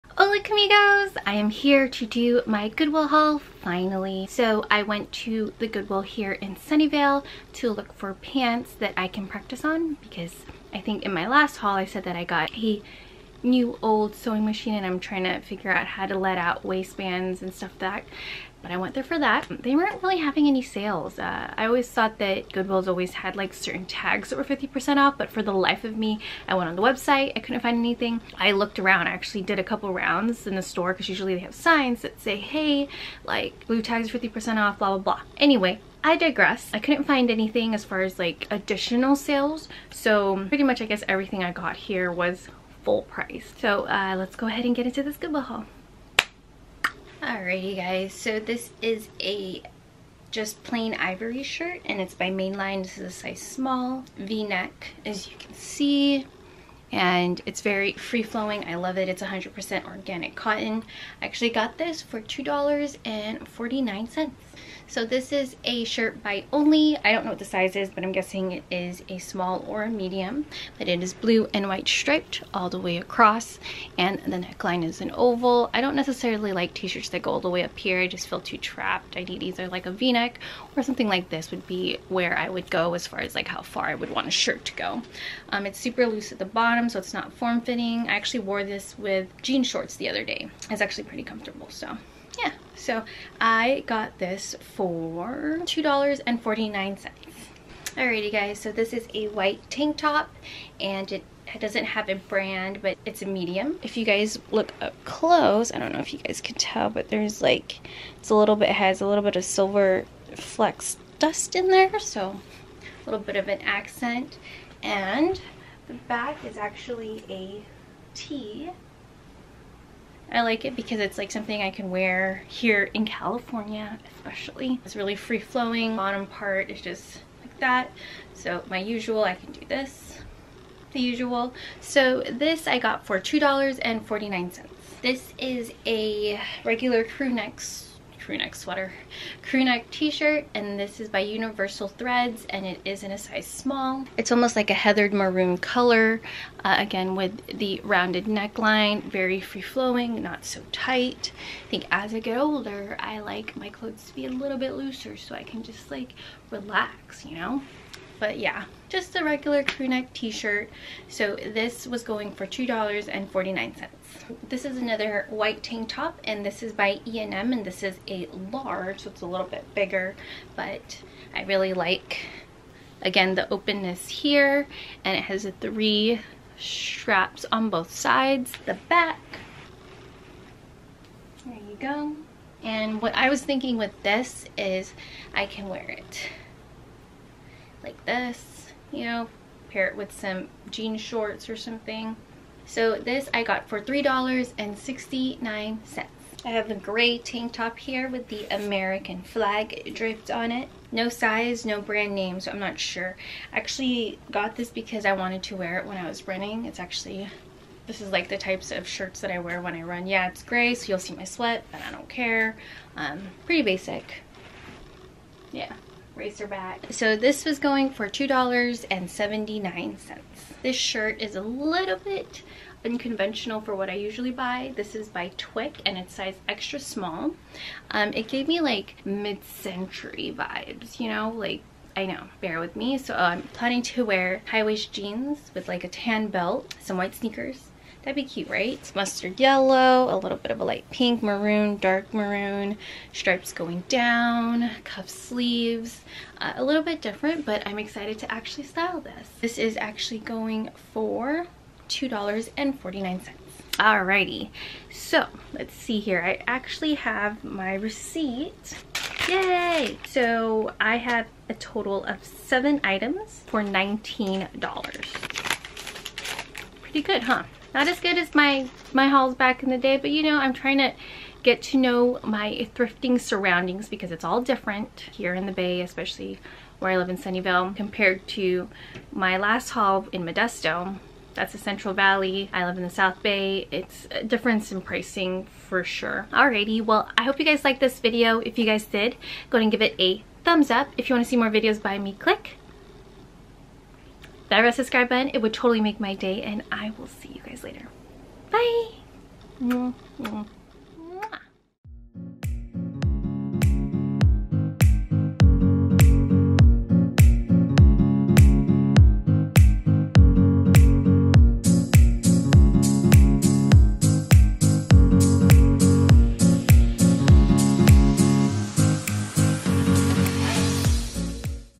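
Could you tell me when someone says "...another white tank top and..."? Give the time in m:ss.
2:44.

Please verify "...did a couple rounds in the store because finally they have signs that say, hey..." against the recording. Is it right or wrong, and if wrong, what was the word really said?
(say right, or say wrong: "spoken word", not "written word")
wrong: "usually", not "finally".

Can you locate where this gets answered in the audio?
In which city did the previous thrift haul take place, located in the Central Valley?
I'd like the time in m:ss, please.
4:40.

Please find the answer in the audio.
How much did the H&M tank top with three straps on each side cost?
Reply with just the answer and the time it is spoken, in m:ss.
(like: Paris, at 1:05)
$3.69, at 3:13.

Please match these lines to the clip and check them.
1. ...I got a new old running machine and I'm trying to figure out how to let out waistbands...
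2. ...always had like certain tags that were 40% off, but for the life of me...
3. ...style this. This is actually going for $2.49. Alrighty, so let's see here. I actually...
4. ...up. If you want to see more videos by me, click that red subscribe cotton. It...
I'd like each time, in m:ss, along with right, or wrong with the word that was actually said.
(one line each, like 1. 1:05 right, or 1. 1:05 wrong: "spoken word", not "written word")
1. 0:12 wrong: "sewing", not "running"
2. 0:22 wrong: "50", not "40"
3. 4:08 right
4. 4:50 wrong: "button", not "cotton".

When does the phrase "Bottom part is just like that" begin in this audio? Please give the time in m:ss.
2:05.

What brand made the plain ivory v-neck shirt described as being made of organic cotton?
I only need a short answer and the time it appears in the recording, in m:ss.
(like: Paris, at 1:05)
Mainline, at 0:52.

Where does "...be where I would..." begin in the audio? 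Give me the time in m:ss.
1:21.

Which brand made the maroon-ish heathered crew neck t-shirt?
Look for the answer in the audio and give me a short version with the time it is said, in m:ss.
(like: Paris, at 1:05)
Universal Threads, at 2:21.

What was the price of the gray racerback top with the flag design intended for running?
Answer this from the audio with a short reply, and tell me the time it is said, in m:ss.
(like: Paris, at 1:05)
$2.79, at 3:38.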